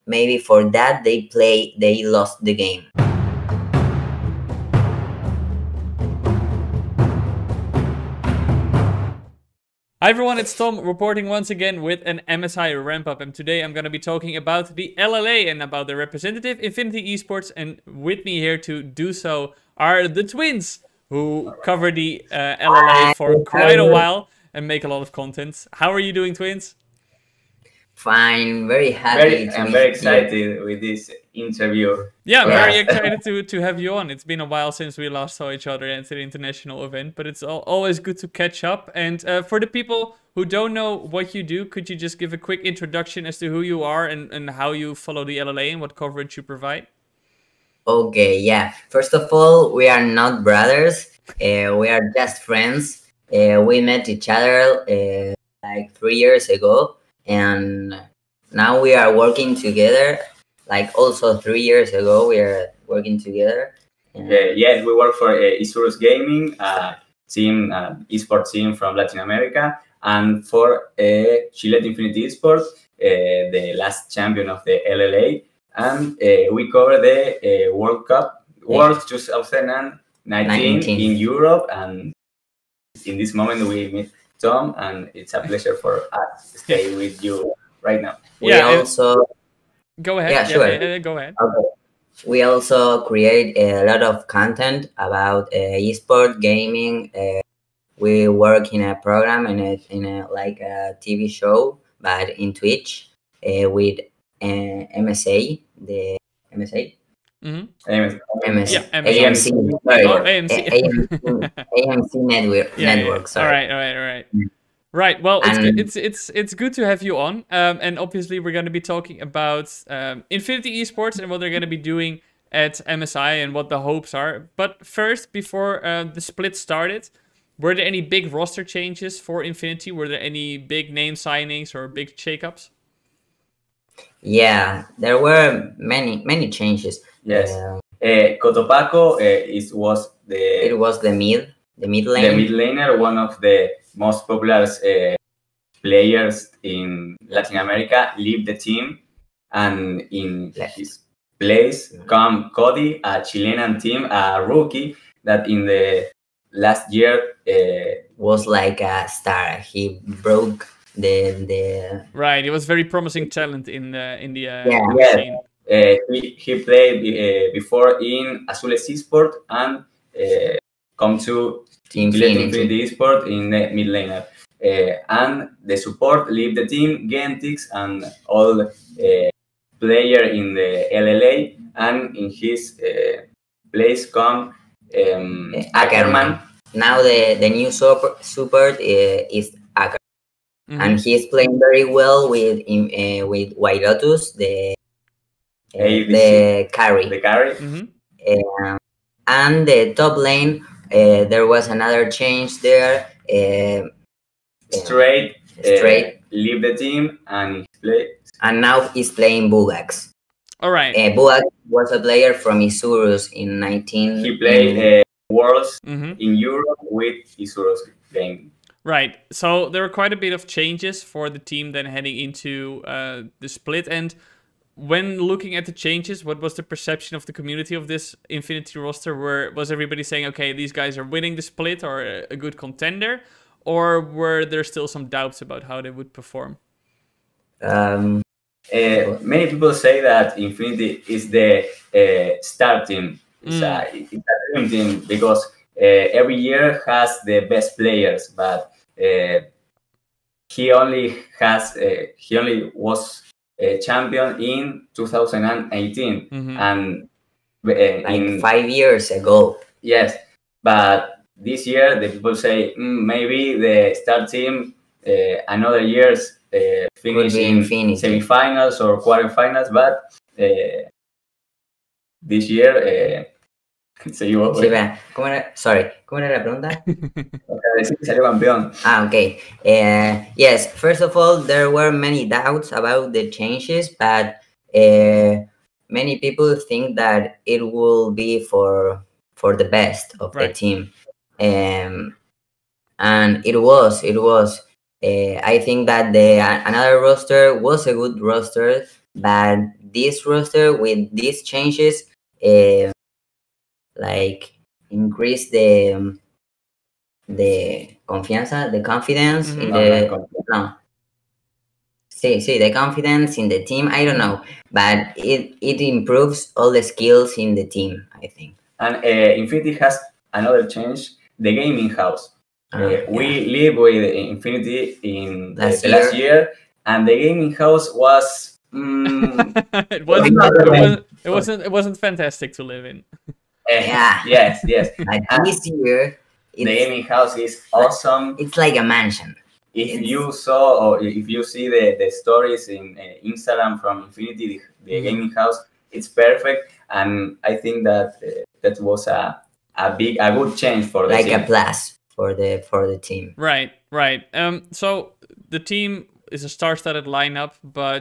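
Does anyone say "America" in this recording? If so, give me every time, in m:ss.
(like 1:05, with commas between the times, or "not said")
1:09, 2:27.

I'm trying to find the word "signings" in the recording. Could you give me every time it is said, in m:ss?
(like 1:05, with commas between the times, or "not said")
2:11.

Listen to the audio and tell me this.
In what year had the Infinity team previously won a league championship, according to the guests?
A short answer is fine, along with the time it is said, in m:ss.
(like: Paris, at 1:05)
2018, at 4:14.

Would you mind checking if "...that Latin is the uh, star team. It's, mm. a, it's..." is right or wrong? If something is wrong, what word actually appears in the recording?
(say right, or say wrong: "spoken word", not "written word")
wrong: "Infinity", not "Latin".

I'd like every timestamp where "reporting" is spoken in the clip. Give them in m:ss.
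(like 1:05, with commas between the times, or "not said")
0:10.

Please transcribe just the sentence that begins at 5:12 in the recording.
See, see the confidence in the team.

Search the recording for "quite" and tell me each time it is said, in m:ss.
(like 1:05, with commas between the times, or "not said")
0:23, 3:39.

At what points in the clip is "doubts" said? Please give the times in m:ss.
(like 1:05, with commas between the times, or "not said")
3:55, 4:42.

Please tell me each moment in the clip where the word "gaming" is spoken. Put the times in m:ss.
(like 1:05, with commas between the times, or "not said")
1:05, 1:36, 5:21, 5:27, 5:36, 5:45.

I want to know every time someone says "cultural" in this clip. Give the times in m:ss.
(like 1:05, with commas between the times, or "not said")
not said.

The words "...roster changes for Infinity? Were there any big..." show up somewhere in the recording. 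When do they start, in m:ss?
2:08.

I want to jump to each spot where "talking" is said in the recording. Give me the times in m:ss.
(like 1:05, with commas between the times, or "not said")
0:13, 1:58.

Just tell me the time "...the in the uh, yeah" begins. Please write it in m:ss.
2:43.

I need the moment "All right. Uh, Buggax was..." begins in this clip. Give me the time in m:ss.
3:30.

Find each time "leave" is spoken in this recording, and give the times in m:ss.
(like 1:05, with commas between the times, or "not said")
2:28, 2:56, 3:26.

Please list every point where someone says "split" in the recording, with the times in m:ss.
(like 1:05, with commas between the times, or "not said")
2:06, 3:43, 3:51.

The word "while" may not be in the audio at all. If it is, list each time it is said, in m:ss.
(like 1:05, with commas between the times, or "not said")
0:23, 0:34.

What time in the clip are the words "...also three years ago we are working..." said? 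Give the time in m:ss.
1:00.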